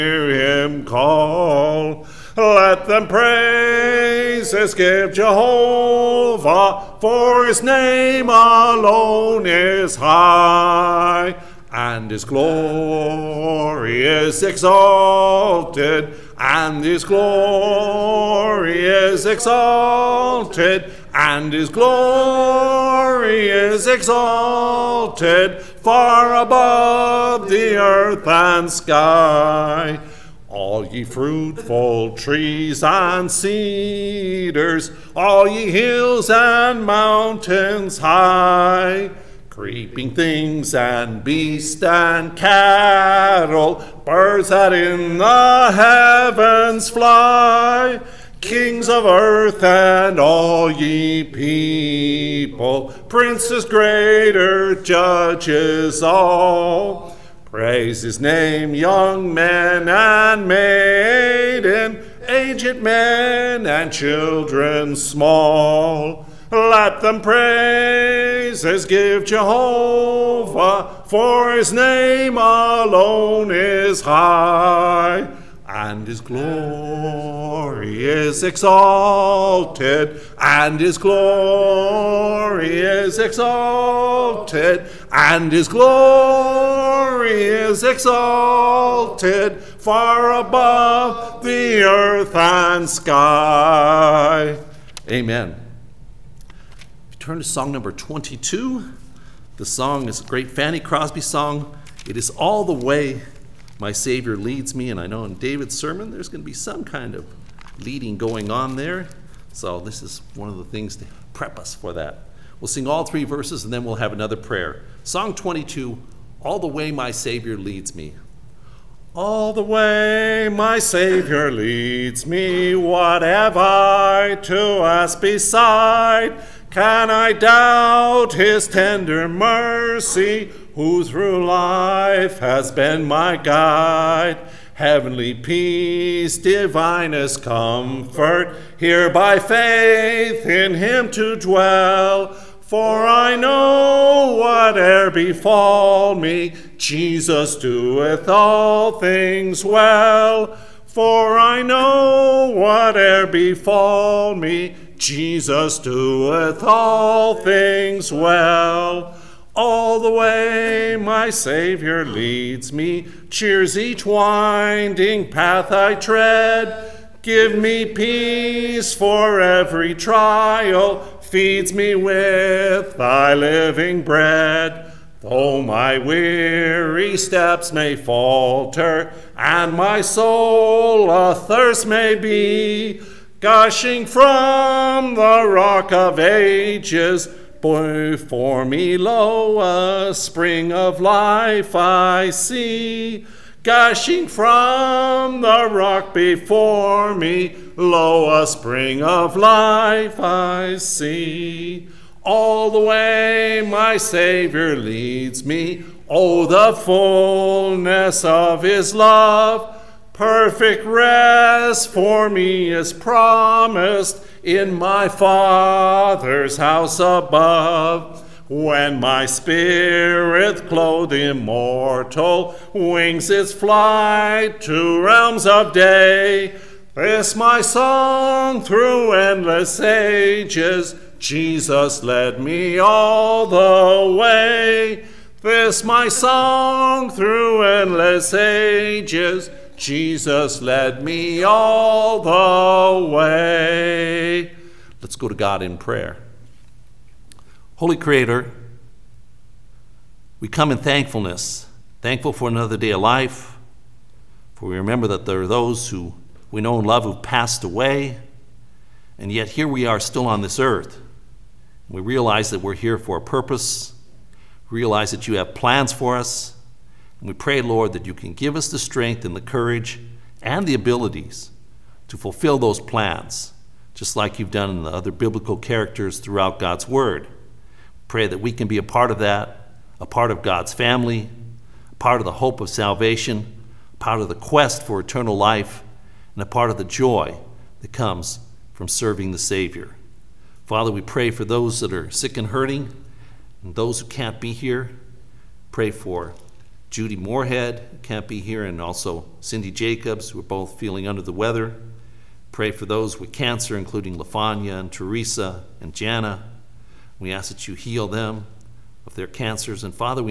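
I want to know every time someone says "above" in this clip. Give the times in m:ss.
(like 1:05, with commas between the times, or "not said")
0:26, 1:30, 3:36.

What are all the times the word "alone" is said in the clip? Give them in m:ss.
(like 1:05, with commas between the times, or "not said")
0:08, 1:12.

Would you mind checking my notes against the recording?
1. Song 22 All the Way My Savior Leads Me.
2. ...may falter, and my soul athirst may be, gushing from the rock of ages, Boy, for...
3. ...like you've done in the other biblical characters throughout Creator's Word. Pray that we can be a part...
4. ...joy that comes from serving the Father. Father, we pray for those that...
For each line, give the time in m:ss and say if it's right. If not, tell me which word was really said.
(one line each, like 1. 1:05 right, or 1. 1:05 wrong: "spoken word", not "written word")
1. 1:55 right
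2. 2:57 right
3. 4:34 wrong: "God", not "Creator"
4. 4:46 wrong: "Savior", not "Father".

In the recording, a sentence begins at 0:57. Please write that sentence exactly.
Praise his name, young men and maiden, aged men and children small.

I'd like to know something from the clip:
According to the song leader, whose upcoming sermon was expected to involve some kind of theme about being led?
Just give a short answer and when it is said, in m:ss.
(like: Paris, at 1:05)
David, at 1:45.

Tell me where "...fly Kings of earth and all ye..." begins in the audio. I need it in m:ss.
0:46.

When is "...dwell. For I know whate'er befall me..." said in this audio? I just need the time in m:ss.
2:21.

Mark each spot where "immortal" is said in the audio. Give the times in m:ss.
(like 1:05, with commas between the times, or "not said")
3:41.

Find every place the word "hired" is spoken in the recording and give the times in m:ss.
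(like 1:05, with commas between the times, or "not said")
not said.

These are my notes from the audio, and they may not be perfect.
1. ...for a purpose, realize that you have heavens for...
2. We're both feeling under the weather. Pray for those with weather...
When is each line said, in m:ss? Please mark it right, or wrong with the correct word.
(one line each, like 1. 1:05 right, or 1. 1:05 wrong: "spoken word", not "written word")
1. 4:22 wrong: "plans", not "heavens"
2. 5:00 wrong: "cancer", not "weather".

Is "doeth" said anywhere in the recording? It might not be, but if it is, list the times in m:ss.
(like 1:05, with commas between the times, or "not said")
2:27, 2:35.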